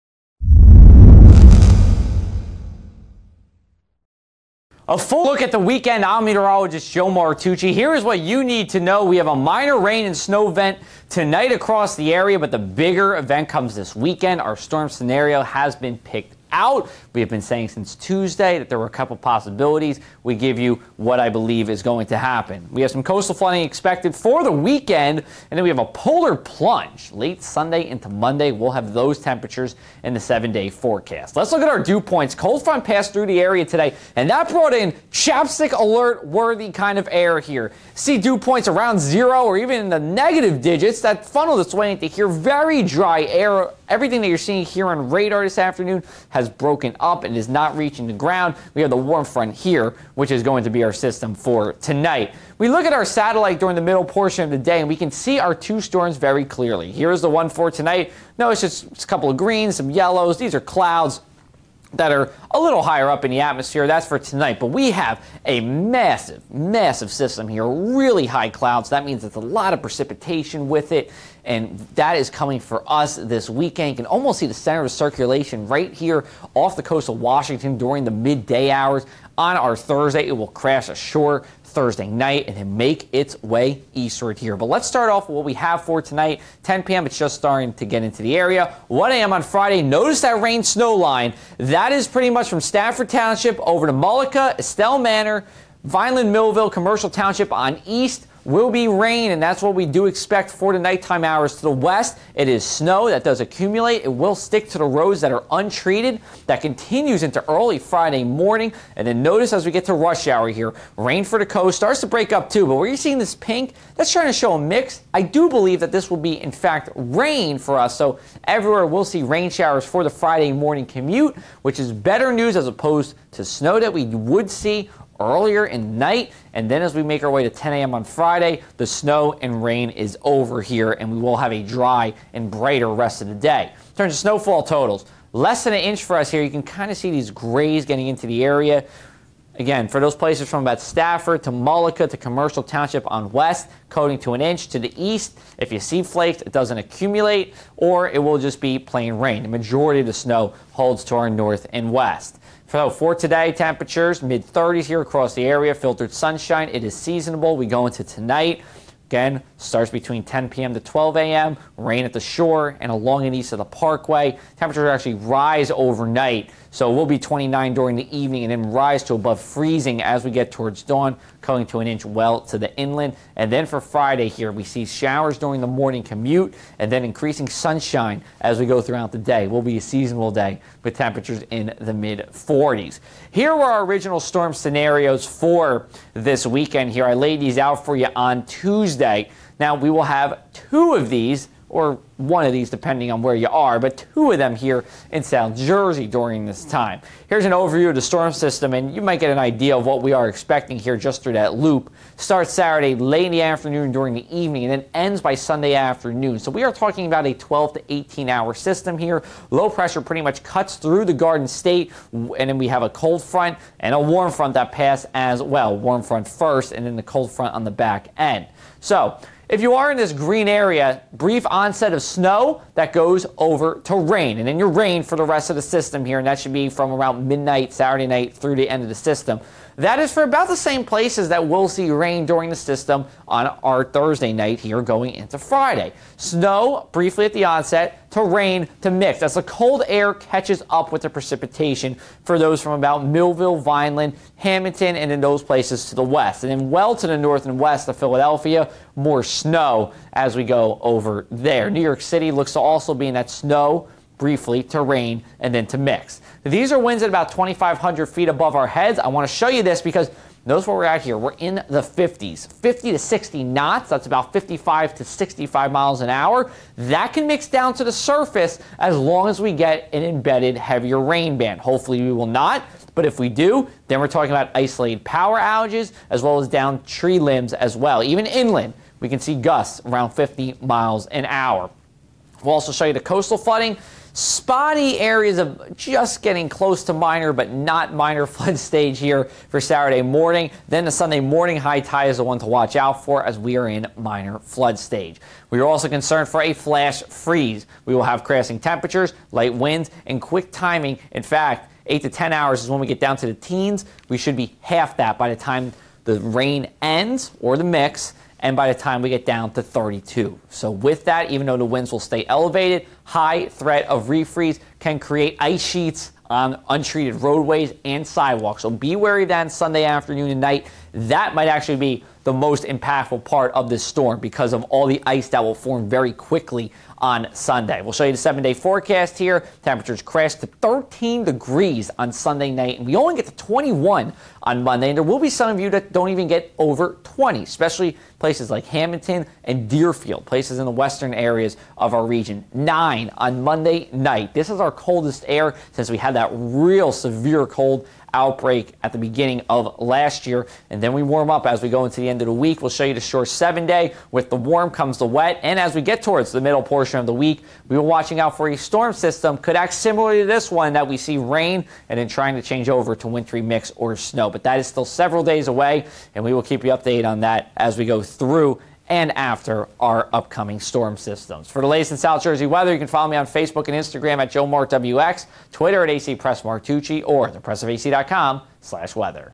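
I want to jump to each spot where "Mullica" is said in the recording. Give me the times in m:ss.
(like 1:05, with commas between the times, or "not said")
1:33, 2:21.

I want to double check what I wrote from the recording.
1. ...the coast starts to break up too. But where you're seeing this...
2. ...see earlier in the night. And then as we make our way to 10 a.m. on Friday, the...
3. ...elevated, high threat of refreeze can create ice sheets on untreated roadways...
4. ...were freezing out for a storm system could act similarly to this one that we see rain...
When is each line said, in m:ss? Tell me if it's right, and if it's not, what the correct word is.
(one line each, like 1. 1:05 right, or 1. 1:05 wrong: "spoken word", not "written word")
1. 1:51 right
2. 2:04 right
3. 5:12 right
4. 5:57 wrong: "watching", not "freezing".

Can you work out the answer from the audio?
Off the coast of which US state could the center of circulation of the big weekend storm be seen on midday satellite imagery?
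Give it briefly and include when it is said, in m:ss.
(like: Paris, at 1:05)
Washington, at 1:17.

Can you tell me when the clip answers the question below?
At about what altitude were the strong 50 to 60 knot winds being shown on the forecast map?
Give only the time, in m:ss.
4:17.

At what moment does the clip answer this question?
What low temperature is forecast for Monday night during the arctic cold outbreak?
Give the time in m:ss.
5:42.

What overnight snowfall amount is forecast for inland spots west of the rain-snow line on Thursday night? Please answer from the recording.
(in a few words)
coating to an inch.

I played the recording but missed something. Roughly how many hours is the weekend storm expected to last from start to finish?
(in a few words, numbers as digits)
12 to 18 hours.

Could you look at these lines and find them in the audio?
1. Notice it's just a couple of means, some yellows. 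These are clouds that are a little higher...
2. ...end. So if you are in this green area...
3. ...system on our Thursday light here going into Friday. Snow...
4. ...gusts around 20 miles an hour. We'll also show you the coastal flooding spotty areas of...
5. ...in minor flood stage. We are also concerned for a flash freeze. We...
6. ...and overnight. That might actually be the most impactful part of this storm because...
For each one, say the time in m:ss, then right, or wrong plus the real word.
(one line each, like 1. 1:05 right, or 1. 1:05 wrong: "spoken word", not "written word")
1. 0:58 wrong: "greens", not "means"
2. 3:38 right
3. 3:52 wrong: "night", not "light"
4. 4:39 wrong: "50", not "20"
5. 4:53 right
6. 5:20 wrong: "night", not "overnight".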